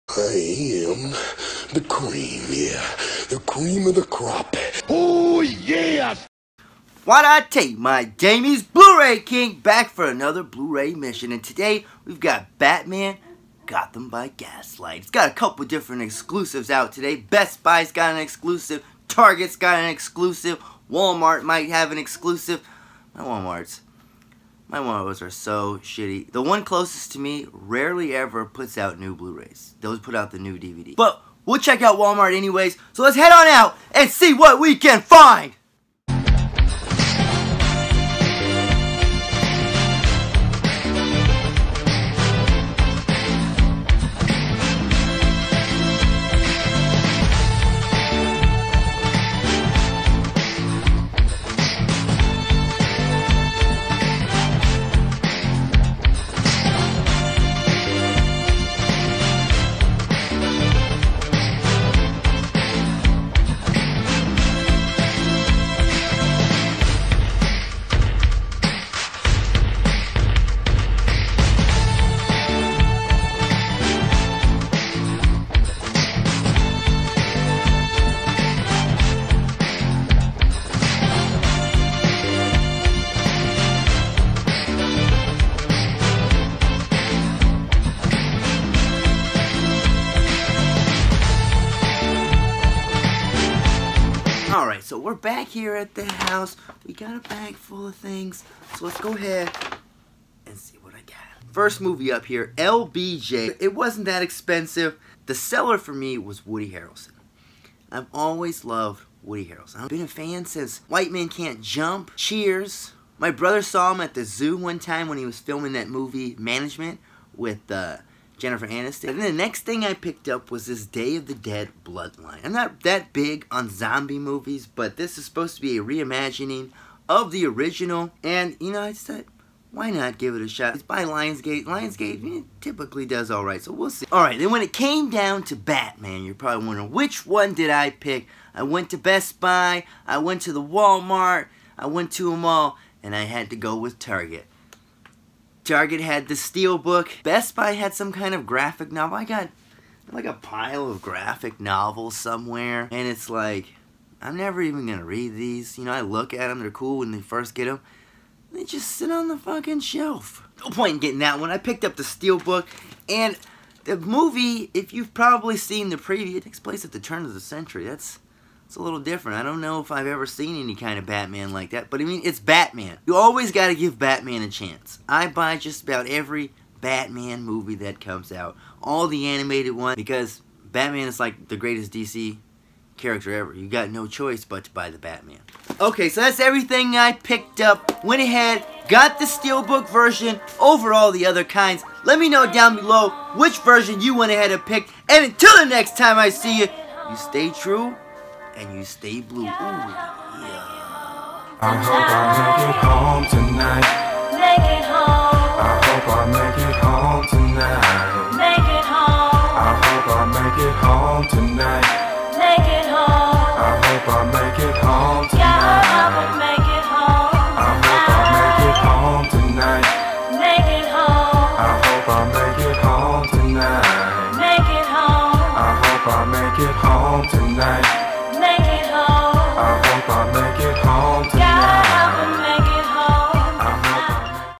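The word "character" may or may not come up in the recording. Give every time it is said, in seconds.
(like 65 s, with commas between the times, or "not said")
182 s.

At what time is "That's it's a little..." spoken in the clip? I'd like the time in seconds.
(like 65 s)
167 s.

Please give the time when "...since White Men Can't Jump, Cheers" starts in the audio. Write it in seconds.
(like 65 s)
110 s.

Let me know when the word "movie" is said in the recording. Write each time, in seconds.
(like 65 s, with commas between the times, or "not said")
101 s, 115 s, 124 s, 163 s, 177 s.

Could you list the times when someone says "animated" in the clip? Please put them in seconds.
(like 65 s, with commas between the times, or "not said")
179 s.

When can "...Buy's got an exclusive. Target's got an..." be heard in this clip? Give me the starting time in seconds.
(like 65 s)
17 s.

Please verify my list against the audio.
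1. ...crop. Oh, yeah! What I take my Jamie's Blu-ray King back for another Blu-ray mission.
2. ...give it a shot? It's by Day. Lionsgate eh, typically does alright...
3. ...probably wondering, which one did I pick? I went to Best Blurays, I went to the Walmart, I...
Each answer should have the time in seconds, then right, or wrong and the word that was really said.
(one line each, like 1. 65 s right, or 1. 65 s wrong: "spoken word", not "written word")
1. 4 s right
2. 130 s wrong: "Lionsgate", not "Day"
3. 136 s wrong: "Buy", not "Blurays".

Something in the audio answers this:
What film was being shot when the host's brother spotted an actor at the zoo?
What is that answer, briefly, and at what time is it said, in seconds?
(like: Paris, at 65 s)
Management, at 116 s.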